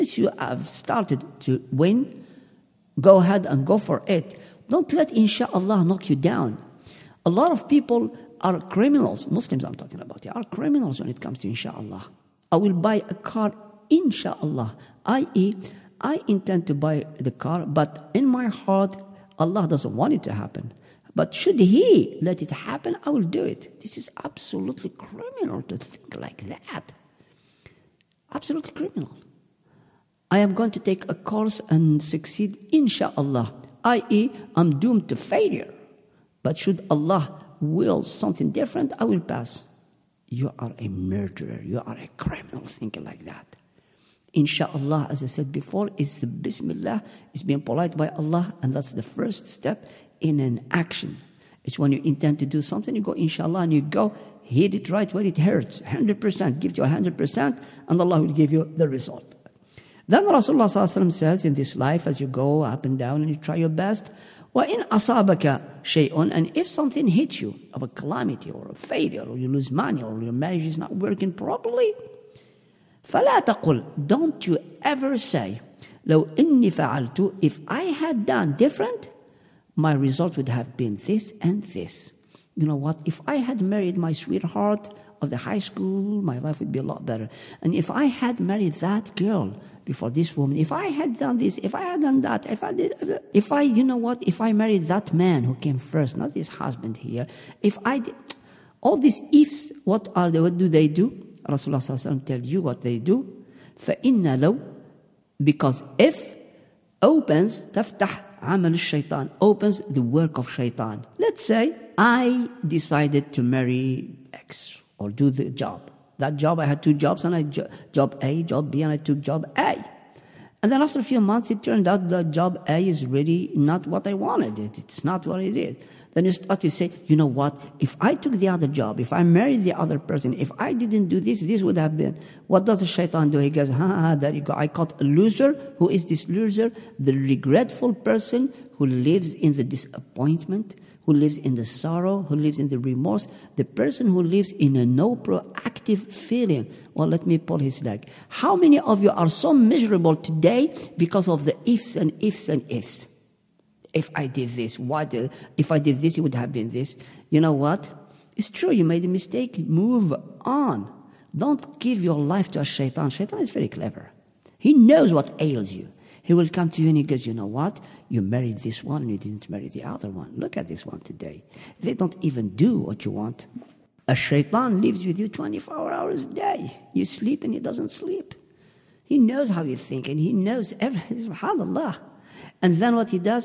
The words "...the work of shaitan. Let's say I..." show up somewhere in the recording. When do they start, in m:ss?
1:49.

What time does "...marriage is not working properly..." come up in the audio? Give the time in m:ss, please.
1:10.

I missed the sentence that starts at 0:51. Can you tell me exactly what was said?
It's when you intend to do something, you go Inshallah, and you go hit it right where it hurts, 100%.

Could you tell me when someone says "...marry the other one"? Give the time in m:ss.
2:49.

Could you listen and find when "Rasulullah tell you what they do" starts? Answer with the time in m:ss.
1:41.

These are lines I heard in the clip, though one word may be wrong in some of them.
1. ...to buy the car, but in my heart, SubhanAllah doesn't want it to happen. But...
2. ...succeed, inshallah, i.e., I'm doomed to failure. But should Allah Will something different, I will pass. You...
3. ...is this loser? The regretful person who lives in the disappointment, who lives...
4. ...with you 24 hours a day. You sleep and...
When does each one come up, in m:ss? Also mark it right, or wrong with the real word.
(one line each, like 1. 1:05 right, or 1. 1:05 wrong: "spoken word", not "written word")
1. 0:16 wrong: "Allah", not "SubhanAllah"
2. 0:32 right
3. 2:15 right
4. 2:55 right.